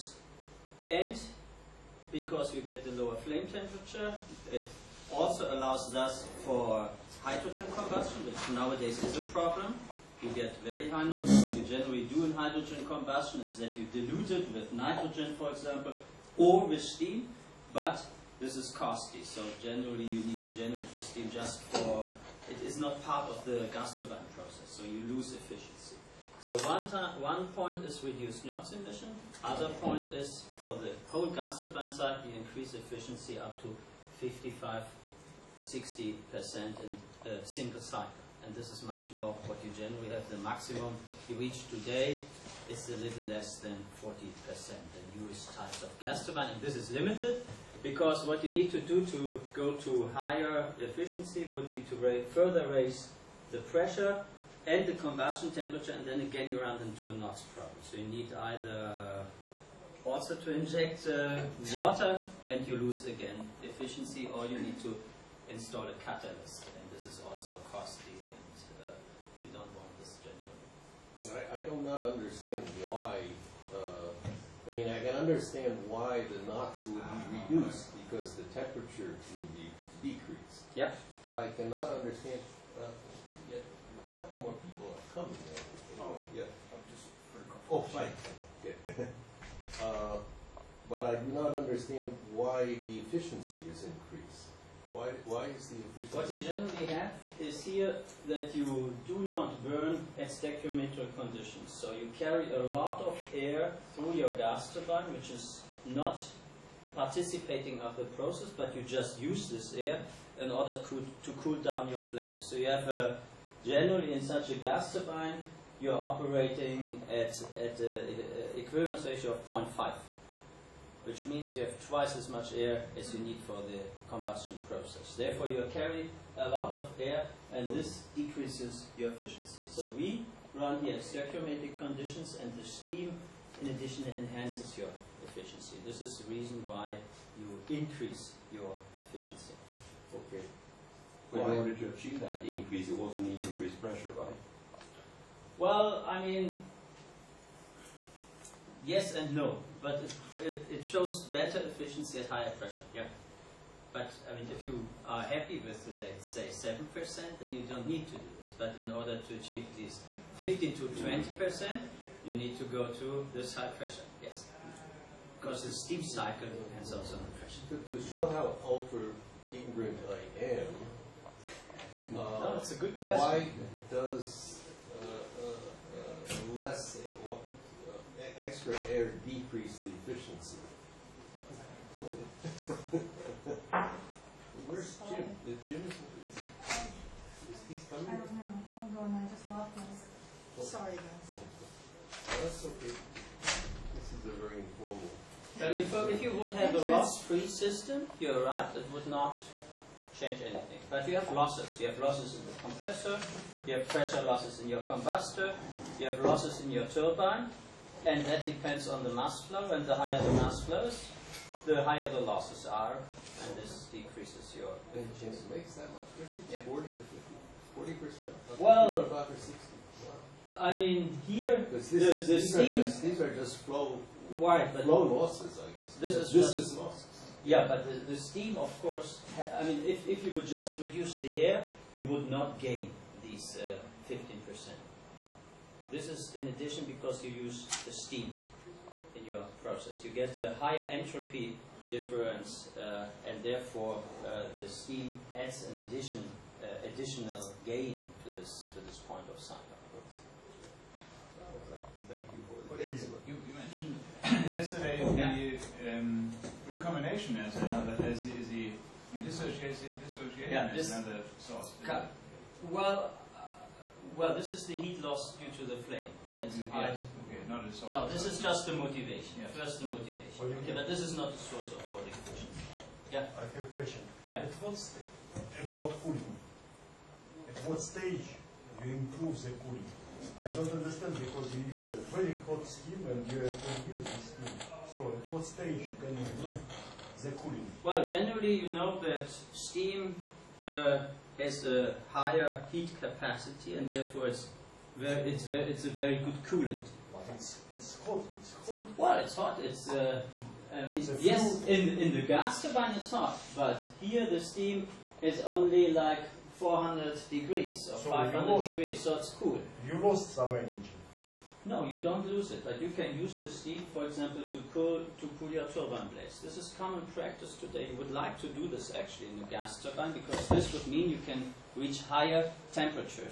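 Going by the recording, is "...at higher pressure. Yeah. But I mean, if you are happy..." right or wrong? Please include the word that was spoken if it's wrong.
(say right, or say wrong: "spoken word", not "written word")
right.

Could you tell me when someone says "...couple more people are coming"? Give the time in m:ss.
1:24.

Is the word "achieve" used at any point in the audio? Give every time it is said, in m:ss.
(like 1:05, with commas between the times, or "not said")
2:21, 2:39.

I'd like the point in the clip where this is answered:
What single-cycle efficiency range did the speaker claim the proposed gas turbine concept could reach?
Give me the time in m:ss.
0:34.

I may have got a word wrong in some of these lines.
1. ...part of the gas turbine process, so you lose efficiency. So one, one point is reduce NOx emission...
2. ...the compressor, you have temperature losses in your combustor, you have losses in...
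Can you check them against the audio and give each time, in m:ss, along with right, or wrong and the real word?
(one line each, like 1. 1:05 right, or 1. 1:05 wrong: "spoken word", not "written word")
1. 0:23 right
2. 3:22 wrong: "pressure", not "temperature".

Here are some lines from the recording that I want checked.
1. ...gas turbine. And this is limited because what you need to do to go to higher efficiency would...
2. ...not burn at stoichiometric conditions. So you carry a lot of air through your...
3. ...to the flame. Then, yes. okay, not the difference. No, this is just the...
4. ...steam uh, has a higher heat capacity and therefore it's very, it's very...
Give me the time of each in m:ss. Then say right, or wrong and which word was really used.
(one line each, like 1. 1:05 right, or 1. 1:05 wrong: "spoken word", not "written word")
1. 0:45 right
2. 1:39 right
3. 4:25 wrong: "source", not "difference"
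4. 4:49 right.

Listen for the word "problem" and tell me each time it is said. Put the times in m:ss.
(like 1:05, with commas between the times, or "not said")
0:09, 0:57.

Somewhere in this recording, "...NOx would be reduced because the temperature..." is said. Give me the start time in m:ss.
1:16.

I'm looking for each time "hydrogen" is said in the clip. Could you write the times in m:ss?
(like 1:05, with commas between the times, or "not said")
0:07, 0:12.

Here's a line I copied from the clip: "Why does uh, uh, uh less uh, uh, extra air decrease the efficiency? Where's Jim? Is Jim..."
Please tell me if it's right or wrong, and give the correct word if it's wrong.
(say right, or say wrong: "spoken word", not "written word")
right.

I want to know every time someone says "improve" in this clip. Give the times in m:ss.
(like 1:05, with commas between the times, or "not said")
4:38, 4:46.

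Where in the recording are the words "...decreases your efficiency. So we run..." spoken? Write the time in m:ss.
2:08.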